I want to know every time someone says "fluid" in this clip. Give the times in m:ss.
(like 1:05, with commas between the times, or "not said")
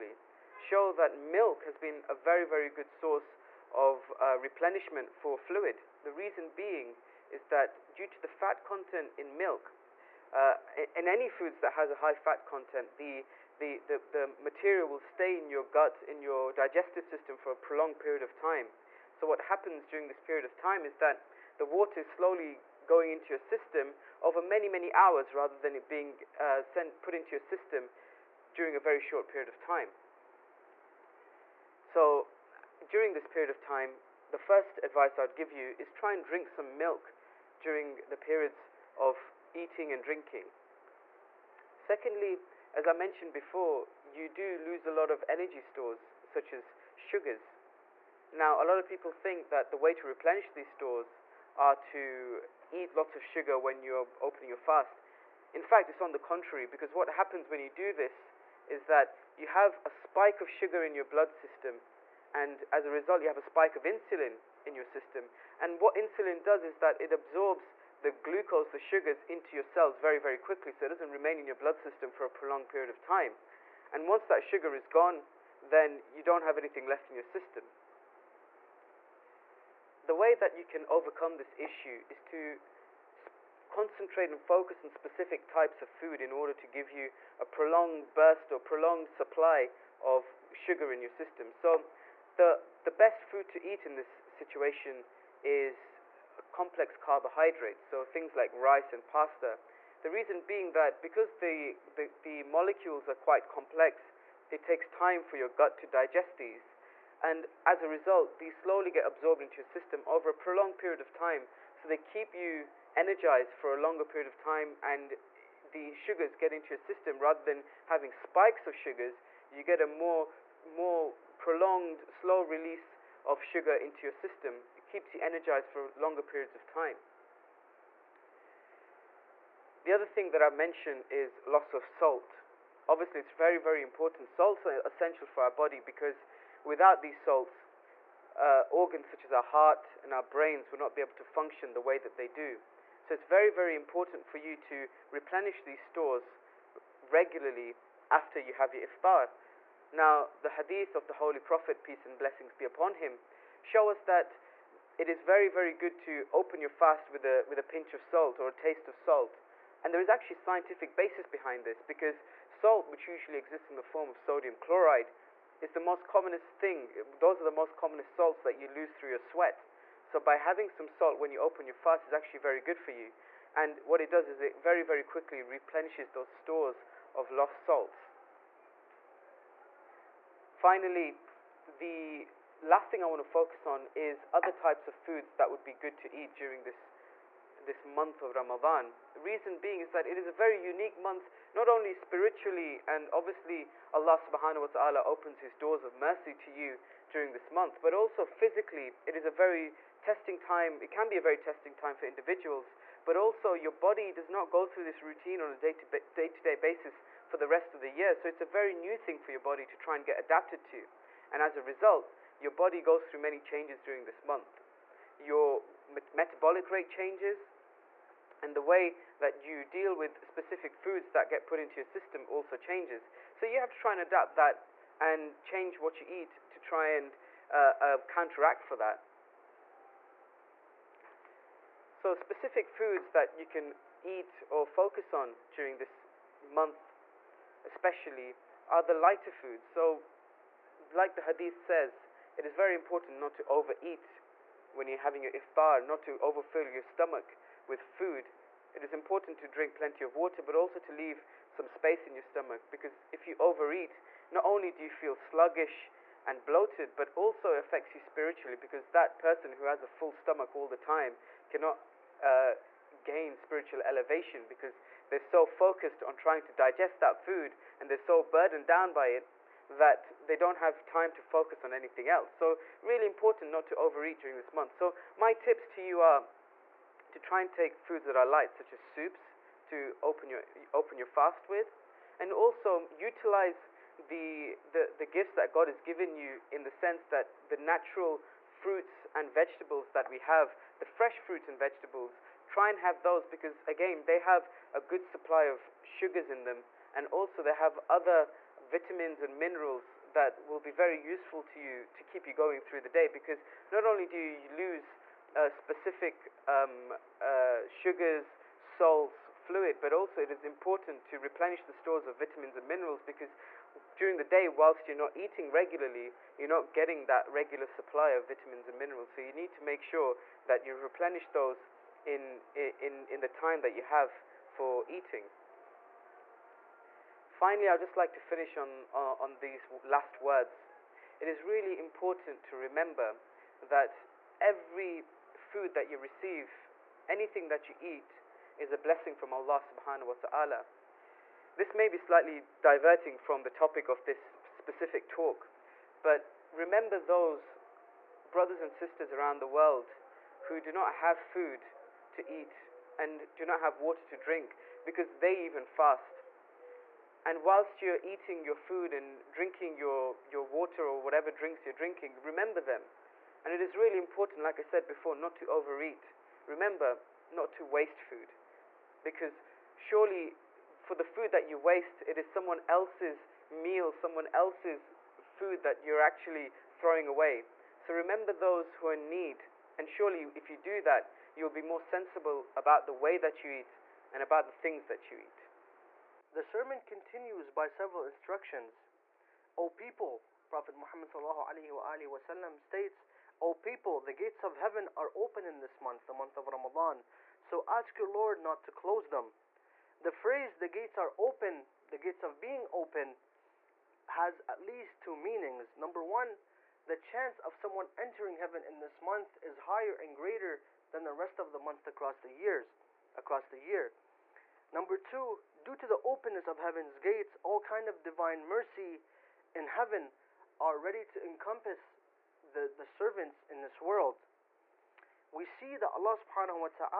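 0:05, 5:09.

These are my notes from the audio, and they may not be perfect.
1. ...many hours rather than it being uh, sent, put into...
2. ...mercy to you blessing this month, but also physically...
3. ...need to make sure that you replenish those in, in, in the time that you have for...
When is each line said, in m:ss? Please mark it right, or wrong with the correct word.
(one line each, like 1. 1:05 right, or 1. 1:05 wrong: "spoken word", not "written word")
1. 0:24 right
2. 3:15 wrong: "during", not "blessing"
3. 5:19 right.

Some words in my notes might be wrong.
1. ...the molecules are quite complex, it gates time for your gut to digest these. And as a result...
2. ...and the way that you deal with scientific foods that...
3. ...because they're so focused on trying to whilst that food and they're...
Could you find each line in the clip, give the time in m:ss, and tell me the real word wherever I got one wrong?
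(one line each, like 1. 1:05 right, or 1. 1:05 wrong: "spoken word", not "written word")
1. 1:42 wrong: "takes", not "gates"
2. 3:38 wrong: "specific", not "scientific"
3. 4:24 wrong: "digest", not "whilst".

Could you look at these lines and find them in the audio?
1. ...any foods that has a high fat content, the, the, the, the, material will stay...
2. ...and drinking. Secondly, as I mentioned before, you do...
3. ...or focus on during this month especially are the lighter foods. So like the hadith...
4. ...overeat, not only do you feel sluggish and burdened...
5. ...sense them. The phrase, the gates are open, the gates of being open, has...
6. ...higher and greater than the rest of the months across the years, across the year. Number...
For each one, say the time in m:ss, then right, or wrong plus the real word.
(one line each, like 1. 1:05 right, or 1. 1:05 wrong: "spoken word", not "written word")
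1. 0:11 right
2. 0:39 right
3. 3:54 right
4. 4:13 wrong: "bloated", not "burdened"
5. 6:38 wrong: "close", not "sense"
6. 6:49 right.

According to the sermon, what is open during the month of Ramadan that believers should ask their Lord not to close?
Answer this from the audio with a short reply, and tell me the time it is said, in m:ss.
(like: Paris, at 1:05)
The gates of heaven, at 6:34.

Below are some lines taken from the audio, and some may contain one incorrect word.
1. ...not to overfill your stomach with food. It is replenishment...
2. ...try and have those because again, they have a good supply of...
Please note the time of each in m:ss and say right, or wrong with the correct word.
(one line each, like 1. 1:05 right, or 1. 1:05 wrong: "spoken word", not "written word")
1. 4:05 wrong: "important", not "replenishment"
2. 4:52 right.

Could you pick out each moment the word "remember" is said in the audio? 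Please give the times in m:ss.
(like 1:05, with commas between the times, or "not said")
5:32, 5:46, 6:02, 6:06, 6:17.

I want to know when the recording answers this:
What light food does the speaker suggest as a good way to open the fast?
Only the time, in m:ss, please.
4:38.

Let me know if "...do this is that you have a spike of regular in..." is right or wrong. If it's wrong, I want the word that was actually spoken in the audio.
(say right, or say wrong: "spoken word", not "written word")
wrong: "sugar", not "regular".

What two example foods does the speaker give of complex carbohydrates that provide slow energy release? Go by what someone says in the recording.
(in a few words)
Rice and pasta.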